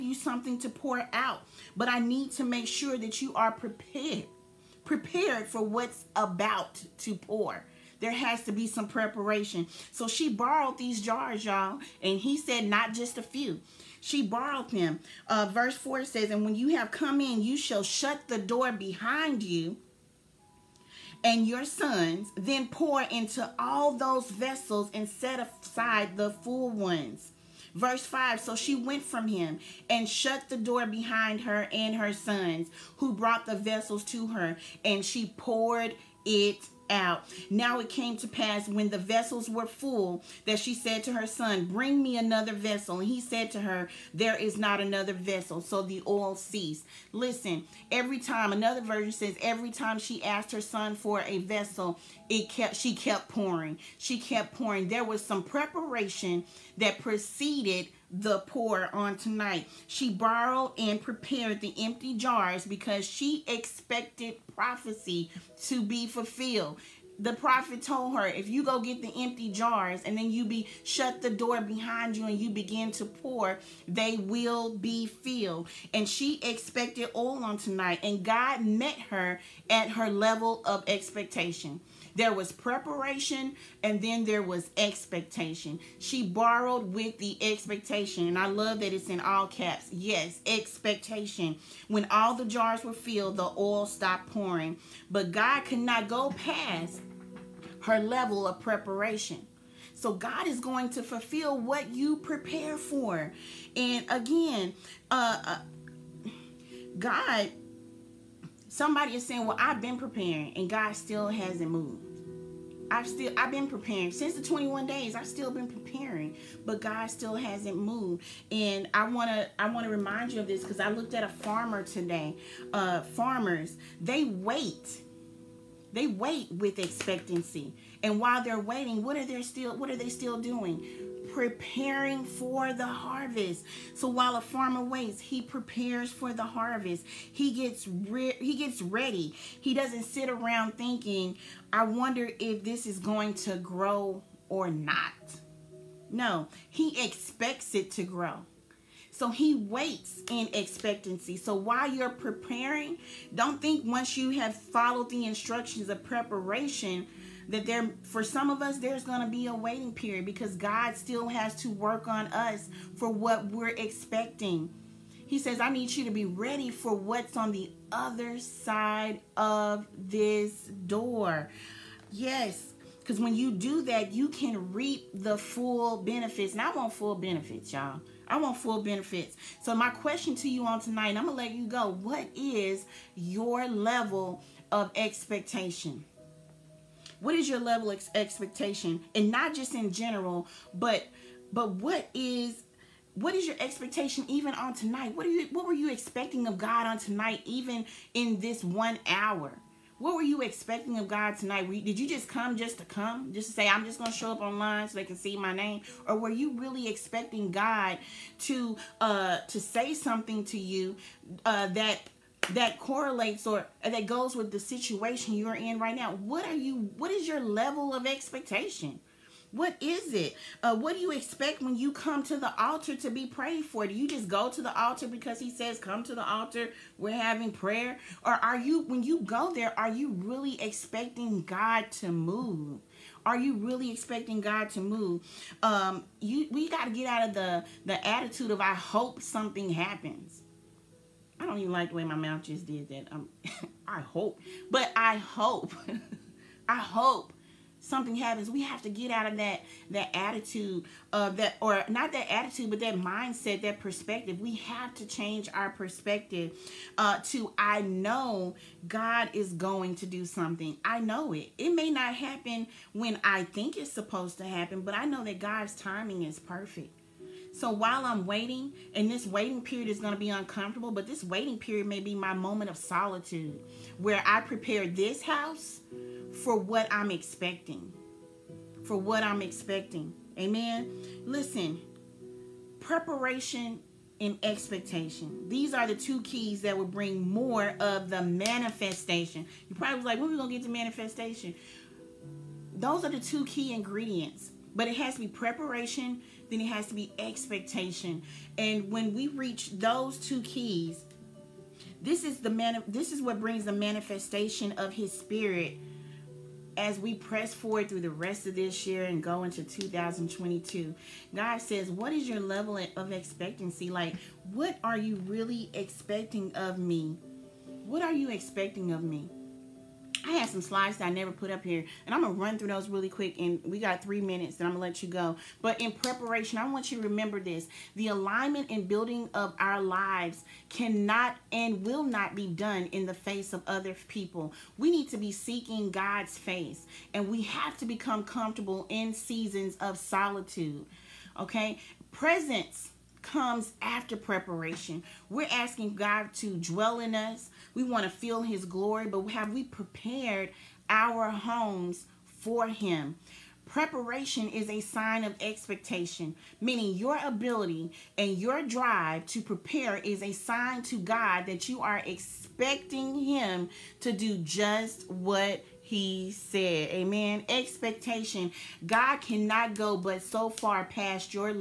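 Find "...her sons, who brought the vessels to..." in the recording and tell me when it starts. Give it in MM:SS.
00:31.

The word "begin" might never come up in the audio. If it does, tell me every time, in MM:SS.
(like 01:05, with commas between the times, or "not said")
01:12.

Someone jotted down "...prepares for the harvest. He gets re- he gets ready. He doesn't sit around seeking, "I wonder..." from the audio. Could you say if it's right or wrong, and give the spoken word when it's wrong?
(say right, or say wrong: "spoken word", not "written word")
wrong: "thinking", not "seeking".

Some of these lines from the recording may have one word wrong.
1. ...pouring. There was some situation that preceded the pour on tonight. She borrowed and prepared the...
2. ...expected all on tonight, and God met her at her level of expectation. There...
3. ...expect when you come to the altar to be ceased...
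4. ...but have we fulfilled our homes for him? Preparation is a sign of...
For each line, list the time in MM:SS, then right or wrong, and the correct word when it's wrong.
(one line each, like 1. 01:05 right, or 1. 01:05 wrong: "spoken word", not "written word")
1. 00:54 wrong: "preparation", not "situation"
2. 01:16 right
3. 03:41 wrong: "prayed", not "ceased"
4. 05:49 wrong: "prepared", not "fulfilled".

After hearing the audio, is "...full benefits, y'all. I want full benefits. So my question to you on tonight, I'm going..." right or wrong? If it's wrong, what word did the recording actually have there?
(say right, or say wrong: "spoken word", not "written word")
right.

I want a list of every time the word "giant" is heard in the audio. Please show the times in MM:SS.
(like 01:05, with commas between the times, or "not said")
not said.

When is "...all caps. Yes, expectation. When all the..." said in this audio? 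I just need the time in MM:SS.
01:29.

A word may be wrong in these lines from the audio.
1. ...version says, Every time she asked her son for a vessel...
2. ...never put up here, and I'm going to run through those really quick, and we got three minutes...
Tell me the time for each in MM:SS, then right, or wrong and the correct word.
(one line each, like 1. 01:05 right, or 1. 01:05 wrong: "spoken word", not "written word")
1. 00:48 right
2. 05:21 right.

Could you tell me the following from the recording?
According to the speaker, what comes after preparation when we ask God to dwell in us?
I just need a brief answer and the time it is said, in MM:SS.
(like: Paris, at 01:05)
Presence, at 05:42.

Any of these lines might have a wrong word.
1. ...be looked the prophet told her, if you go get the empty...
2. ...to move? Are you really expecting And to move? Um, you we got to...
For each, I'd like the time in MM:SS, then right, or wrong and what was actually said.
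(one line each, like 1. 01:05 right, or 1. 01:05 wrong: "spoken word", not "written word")
1. 01:05 wrong: "fulfilled", not "looked"
2. 03:52 wrong: "God", not "And".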